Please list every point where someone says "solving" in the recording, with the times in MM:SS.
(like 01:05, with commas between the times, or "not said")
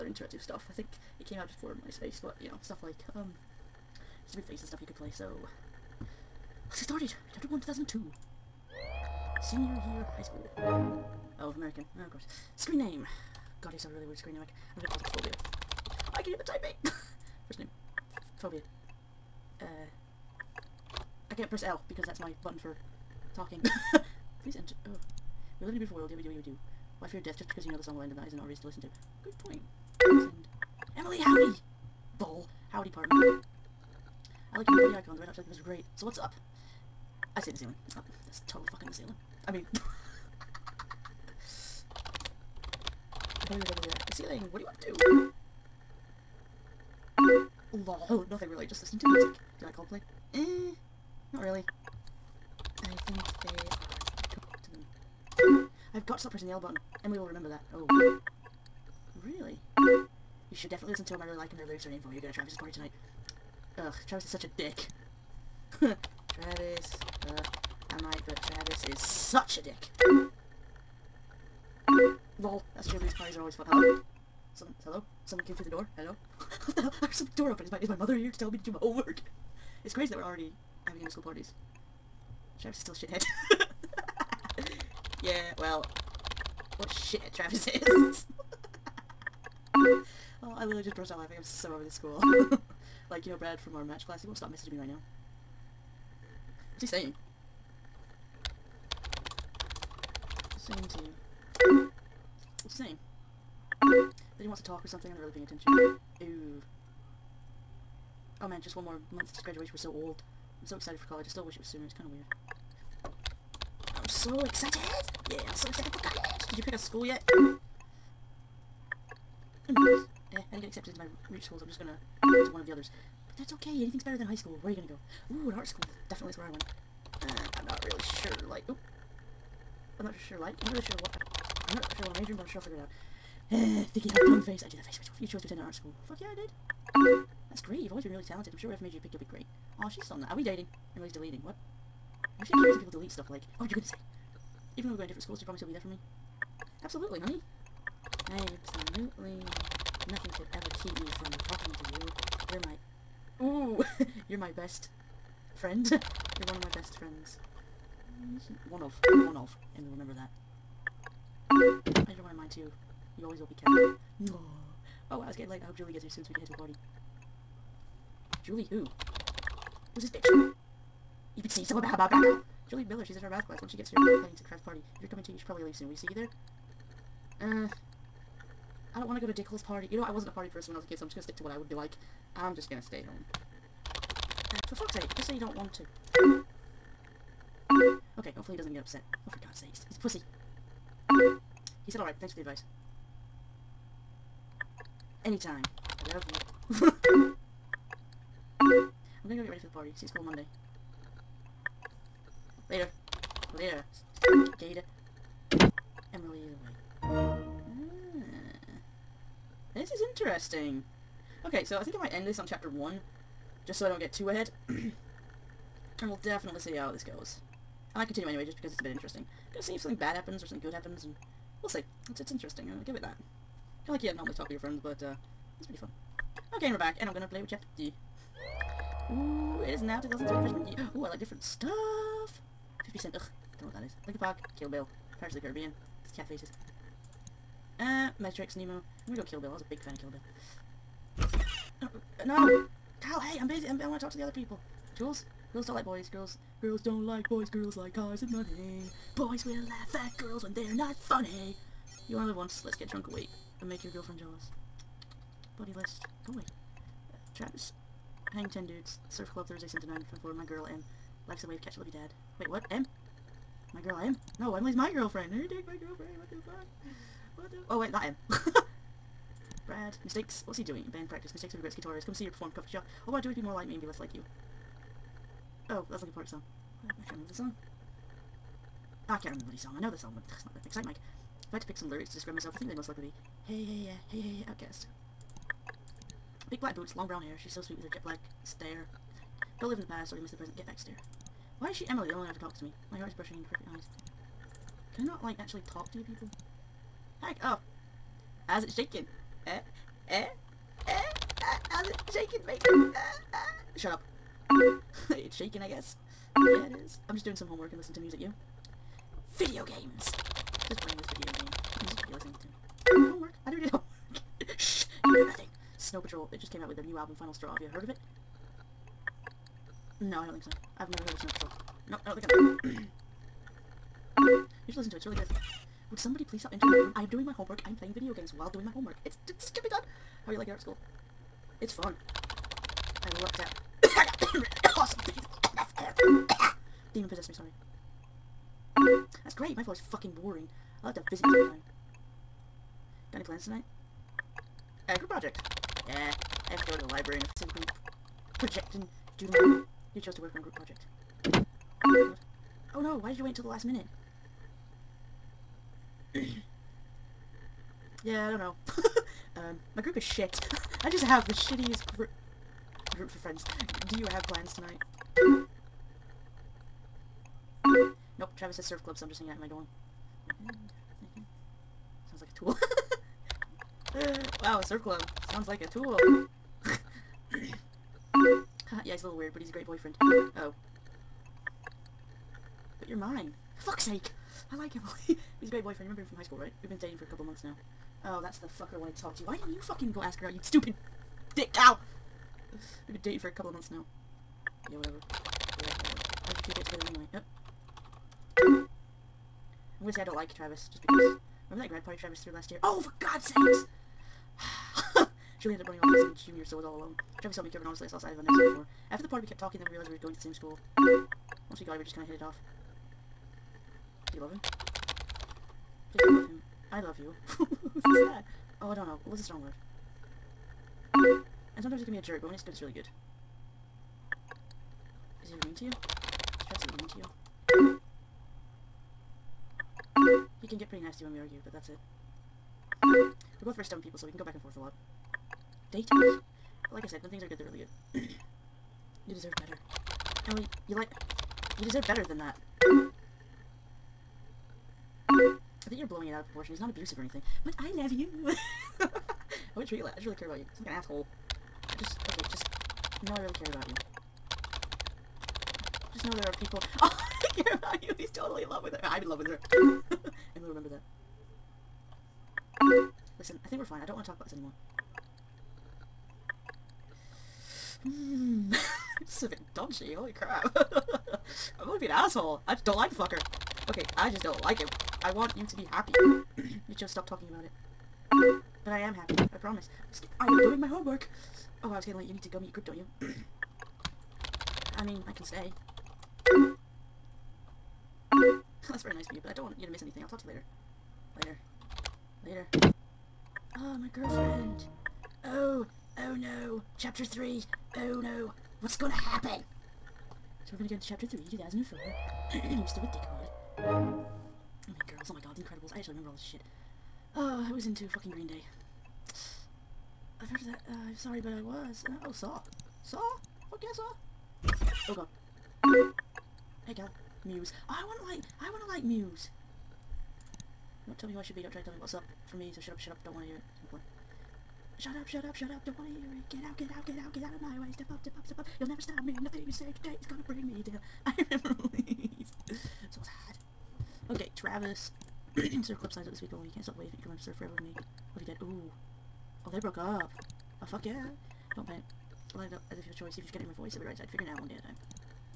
not said.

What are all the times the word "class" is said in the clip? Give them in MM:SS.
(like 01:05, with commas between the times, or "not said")
01:34, 02:53.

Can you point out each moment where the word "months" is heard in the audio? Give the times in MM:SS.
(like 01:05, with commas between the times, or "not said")
01:49, 06:27, 06:33.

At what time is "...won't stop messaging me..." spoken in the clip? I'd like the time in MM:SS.
01:34.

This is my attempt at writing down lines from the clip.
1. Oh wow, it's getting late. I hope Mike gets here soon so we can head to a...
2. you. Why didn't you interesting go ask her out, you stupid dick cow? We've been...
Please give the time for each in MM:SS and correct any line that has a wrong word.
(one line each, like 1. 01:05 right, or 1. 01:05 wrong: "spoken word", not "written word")
1. 02:45 wrong: "Julie", not "Mike"
2. 06:29 wrong: "fucking", not "interesting".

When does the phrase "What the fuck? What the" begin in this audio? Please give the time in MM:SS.
04:26.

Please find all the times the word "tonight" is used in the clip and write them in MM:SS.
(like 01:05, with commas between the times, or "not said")
01:02, 05:43, 06:04.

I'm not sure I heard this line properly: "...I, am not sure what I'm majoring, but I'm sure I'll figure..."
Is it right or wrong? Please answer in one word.
right.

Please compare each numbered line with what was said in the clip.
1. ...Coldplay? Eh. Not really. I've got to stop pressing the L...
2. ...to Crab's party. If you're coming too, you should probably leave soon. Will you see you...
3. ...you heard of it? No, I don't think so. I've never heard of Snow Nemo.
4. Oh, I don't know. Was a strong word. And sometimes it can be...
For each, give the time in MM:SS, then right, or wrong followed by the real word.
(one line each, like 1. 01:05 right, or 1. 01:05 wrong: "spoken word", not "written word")
1. 00:49 right
2. 02:54 right
3. 05:17 wrong: "Patrol", not "Nemo"
4. 06:58 right.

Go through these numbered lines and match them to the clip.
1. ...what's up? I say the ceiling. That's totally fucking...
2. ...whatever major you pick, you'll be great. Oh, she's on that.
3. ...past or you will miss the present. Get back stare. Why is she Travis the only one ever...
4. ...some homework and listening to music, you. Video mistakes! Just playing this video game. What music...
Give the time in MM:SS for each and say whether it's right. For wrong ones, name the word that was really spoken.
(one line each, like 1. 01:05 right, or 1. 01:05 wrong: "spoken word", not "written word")
1. 00:36 right
2. 02:18 right
3. 04:49 wrong: "Emily", not "Travis"
4. 05:07 wrong: "games", not "mistakes".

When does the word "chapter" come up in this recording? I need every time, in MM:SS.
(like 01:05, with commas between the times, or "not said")
00:07, 03:32, 03:47, 08:16, 08:20.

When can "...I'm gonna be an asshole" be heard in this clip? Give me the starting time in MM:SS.
07:51.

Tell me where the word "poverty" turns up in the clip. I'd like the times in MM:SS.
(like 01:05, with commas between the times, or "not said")
not said.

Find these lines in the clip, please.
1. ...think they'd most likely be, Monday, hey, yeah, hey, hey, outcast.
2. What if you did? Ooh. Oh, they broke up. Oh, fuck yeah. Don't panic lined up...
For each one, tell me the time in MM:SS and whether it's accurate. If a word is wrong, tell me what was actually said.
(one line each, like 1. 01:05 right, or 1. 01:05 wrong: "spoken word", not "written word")
1. 04:42 wrong: "Hey", not "Monday"
2. 08:58 right.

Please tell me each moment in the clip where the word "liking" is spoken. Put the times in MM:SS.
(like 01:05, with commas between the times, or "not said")
05:30.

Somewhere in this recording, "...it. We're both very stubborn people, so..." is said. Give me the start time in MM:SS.
07:11.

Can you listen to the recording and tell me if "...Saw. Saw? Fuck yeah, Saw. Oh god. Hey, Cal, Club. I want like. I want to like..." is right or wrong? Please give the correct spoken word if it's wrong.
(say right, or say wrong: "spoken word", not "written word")
wrong: "Muse", not "Club".